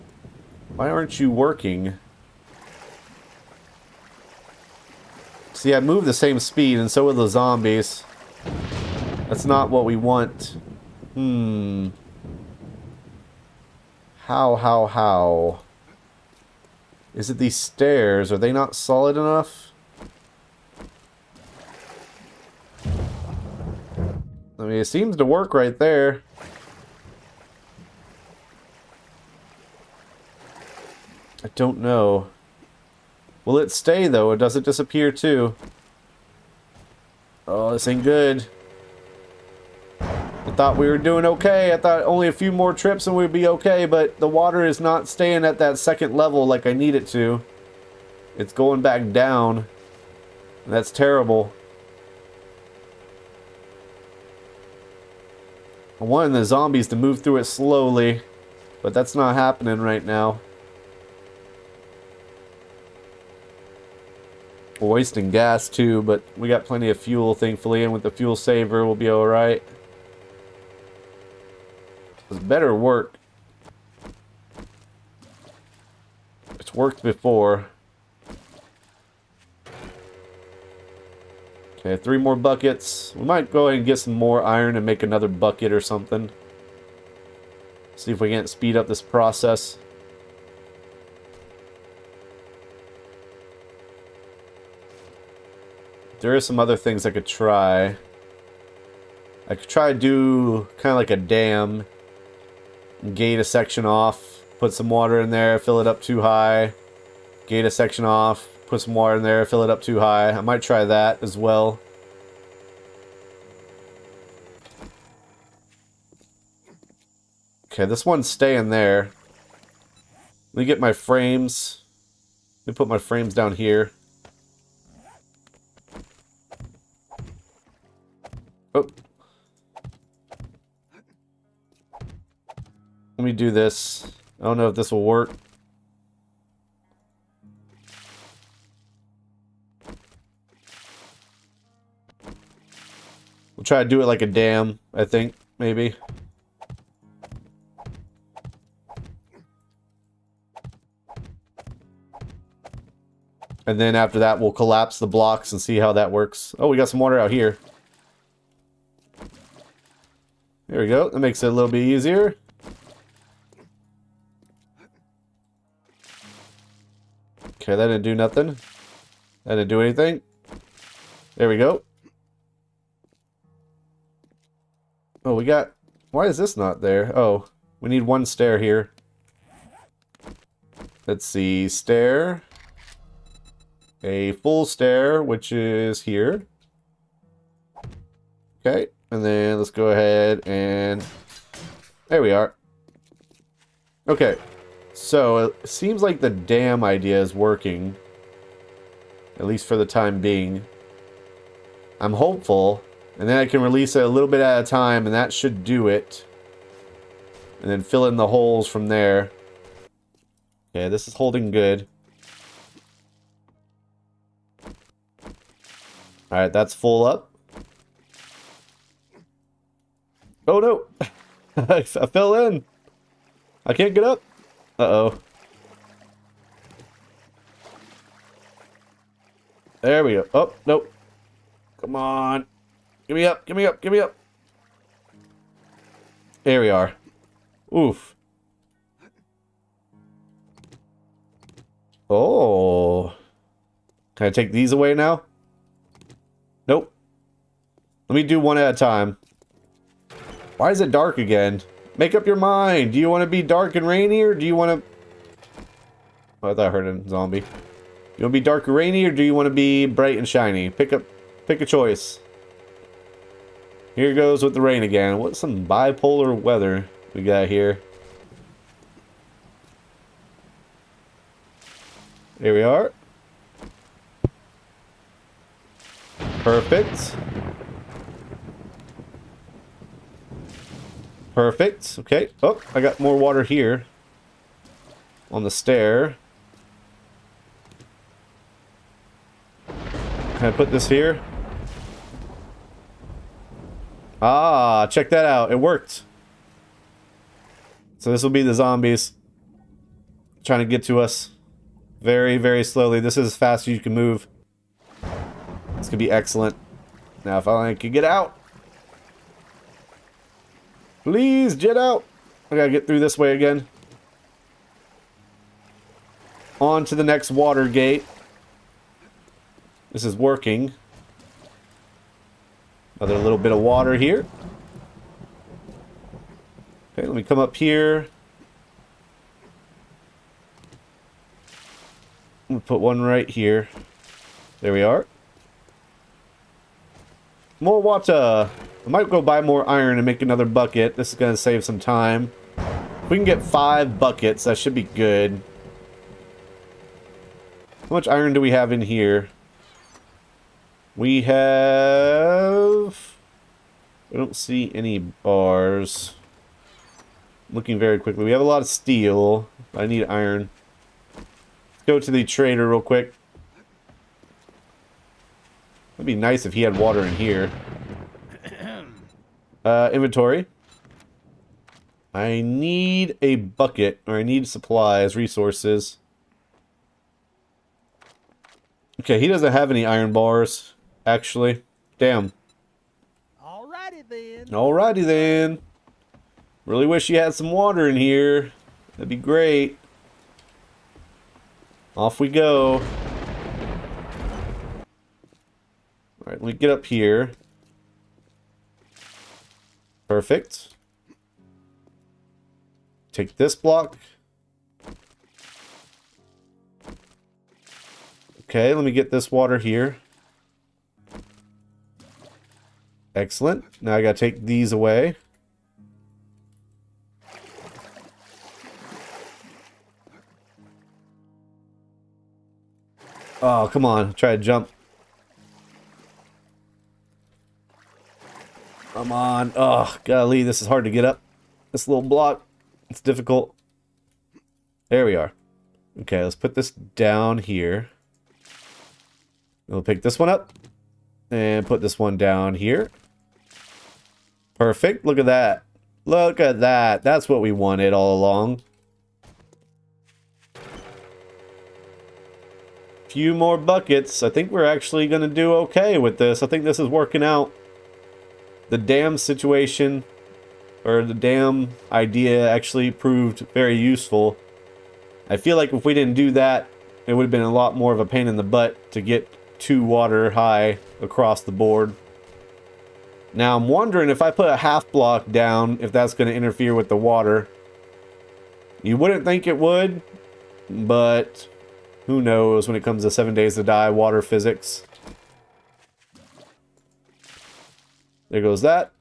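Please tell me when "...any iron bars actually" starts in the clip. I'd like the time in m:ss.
6:19.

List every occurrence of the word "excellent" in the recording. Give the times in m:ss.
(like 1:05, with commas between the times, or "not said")
5:06, 6:53.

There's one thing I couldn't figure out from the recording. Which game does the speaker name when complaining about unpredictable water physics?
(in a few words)
Seven Days to Die.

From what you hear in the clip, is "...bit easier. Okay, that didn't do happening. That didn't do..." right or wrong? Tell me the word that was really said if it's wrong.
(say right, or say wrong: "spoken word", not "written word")
wrong: "nothing", not "happening".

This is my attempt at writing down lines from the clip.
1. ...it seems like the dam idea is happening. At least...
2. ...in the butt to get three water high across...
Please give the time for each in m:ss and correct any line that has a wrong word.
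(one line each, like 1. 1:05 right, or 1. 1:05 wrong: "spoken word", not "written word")
1. 3:15 wrong: "working", not "happening"
2. 7:48 wrong: "two", not "three".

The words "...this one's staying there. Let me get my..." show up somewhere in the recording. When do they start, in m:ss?
1:57.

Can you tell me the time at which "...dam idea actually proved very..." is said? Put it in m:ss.
7:41.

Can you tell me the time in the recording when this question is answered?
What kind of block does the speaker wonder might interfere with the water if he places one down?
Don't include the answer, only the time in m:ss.
7:54.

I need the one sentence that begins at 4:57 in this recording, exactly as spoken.
So this will be the zombies trying to get to us very, very slowly.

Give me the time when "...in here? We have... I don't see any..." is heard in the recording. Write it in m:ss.
5:48.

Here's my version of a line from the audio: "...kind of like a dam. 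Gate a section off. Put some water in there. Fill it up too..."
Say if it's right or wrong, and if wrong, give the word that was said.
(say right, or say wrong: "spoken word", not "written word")
right.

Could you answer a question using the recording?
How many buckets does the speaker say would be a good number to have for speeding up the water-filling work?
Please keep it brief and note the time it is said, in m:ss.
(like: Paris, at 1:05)
5, at 5:43.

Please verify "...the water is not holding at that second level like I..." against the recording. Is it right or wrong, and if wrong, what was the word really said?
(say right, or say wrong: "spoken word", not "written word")
wrong: "staying", not "holding".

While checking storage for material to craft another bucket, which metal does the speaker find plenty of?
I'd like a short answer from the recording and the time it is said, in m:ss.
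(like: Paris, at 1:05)
steel, at 5:58.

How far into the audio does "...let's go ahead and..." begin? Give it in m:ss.
3:09.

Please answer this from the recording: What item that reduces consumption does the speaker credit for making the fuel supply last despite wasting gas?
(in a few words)
fuel saver.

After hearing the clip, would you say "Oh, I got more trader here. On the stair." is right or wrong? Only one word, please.
wrong.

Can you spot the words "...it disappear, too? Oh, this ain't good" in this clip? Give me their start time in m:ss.
0:34.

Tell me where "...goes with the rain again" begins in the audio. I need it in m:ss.
4:24.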